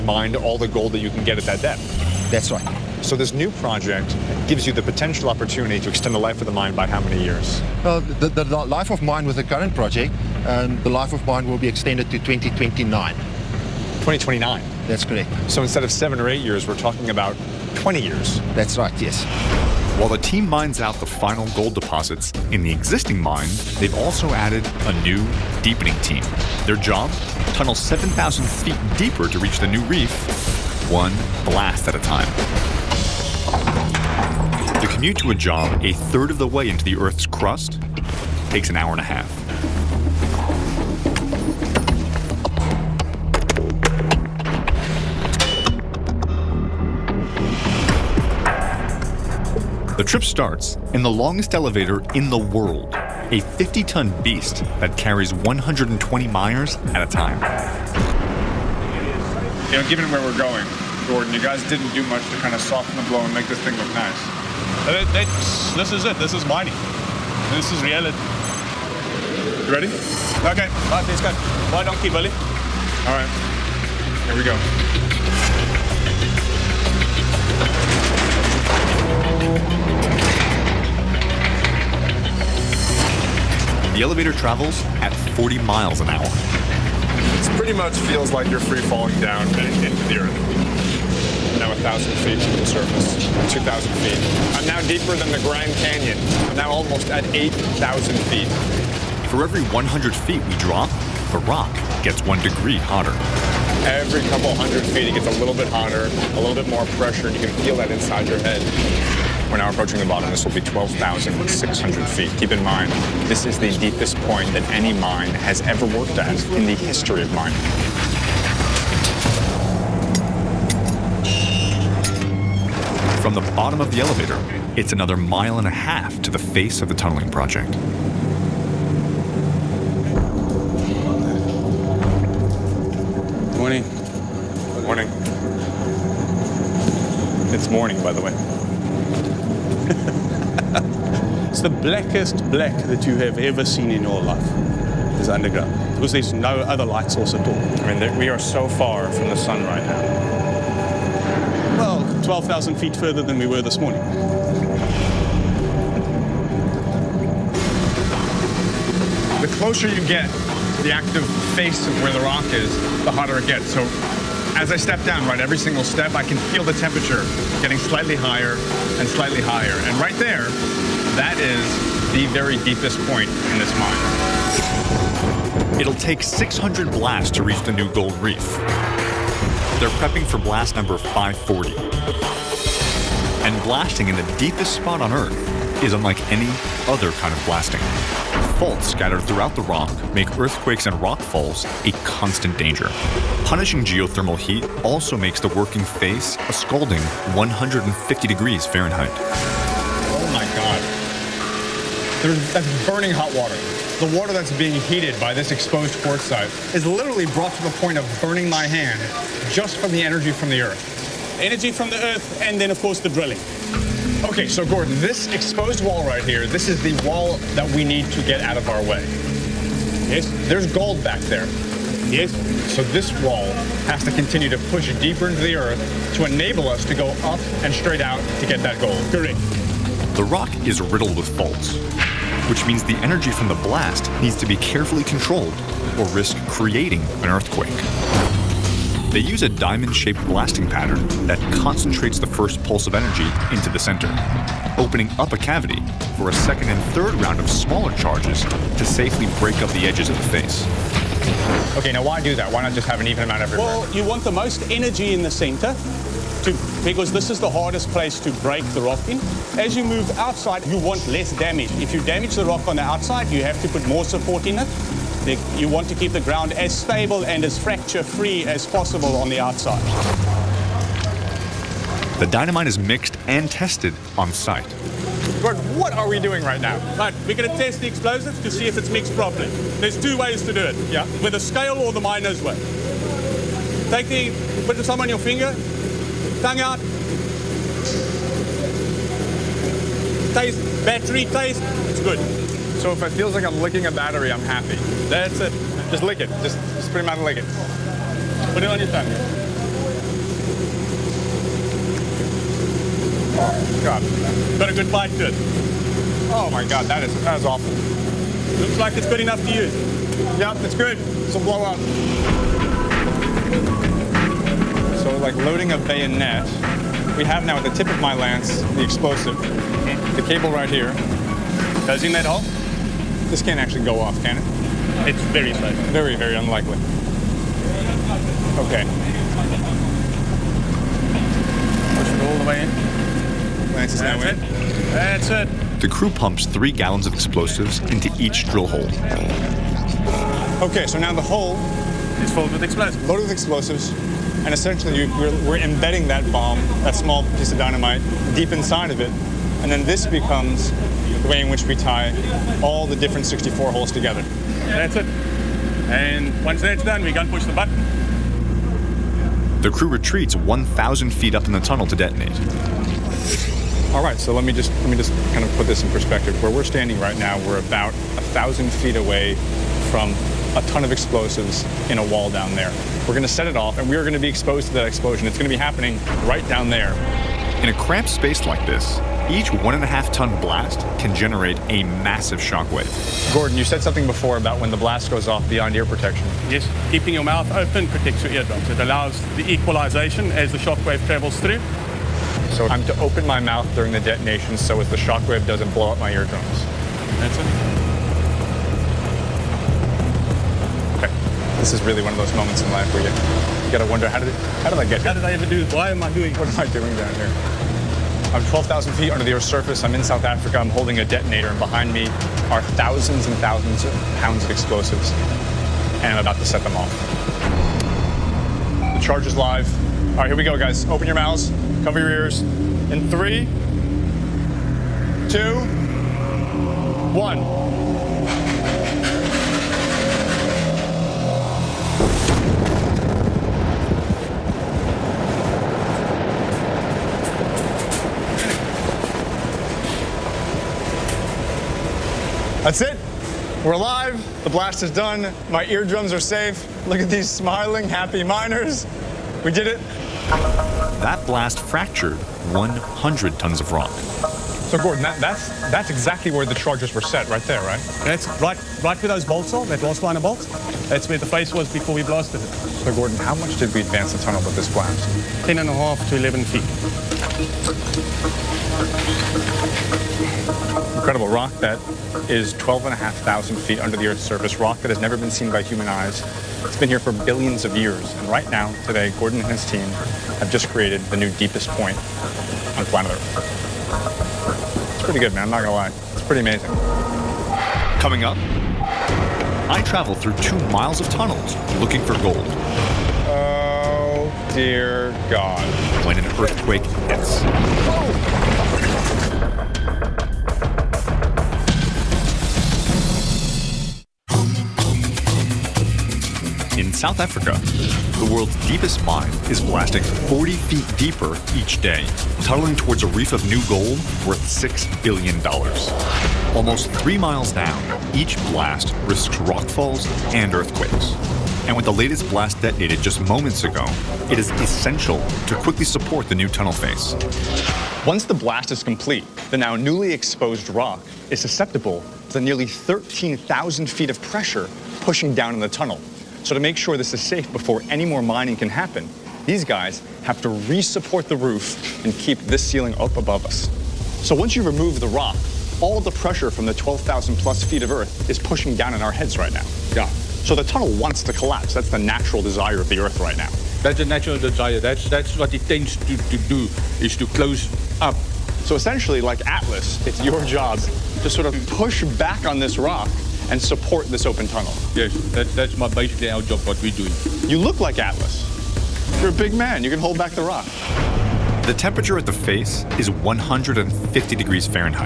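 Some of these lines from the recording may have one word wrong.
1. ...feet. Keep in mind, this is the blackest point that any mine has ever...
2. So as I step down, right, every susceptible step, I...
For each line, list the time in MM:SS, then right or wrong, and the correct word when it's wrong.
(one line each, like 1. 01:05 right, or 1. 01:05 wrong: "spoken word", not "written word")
1. 01:52 wrong: "deepest", not "blackest"
2. 02:43 wrong: "single", not "susceptible".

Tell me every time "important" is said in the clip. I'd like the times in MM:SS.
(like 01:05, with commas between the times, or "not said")
not said.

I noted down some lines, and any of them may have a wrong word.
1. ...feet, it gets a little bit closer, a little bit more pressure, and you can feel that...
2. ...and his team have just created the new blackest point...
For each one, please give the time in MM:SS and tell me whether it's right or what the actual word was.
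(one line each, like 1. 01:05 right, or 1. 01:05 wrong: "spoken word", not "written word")
1. 01:44 wrong: "hotter", not "closer"
2. 07:59 wrong: "deepest", not "blackest".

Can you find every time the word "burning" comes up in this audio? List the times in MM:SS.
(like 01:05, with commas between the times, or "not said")
03:22, 03:28.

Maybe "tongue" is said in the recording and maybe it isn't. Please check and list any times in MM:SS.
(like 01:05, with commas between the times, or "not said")
04:46, 04:58.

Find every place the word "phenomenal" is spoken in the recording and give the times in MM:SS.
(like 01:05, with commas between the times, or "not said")
not said.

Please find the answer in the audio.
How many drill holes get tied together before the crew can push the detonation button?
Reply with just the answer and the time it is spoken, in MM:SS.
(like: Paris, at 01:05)
64, at 05:53.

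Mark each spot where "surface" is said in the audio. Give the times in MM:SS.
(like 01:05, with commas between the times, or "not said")
01:32, 06:49, 07:54.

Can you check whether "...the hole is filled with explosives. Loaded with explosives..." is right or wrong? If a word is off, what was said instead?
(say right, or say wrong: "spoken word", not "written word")
right.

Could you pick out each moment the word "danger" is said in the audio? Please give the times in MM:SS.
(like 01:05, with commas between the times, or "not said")
03:12.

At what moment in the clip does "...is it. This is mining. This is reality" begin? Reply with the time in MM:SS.
01:05.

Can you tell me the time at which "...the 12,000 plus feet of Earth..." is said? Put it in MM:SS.
09:06.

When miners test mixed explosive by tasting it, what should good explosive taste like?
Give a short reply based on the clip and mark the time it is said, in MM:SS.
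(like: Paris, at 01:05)
A battery, at 04:50.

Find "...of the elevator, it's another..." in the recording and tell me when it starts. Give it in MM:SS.
02:03.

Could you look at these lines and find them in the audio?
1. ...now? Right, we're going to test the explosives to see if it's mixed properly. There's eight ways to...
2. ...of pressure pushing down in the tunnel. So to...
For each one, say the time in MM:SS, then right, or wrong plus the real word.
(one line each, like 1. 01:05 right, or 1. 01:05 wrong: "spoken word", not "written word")
1. 04:36 wrong: "two", not "eight"
2. 08:54 right.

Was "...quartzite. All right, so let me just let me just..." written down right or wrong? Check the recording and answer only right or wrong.
wrong.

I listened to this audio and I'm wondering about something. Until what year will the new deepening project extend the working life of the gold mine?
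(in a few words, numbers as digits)
2029.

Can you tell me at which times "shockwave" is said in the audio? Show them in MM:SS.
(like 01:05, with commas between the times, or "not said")
06:22, 06:30, 06:34.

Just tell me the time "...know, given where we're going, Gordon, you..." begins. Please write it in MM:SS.
00:59.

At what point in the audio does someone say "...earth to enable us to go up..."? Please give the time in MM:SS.
03:45.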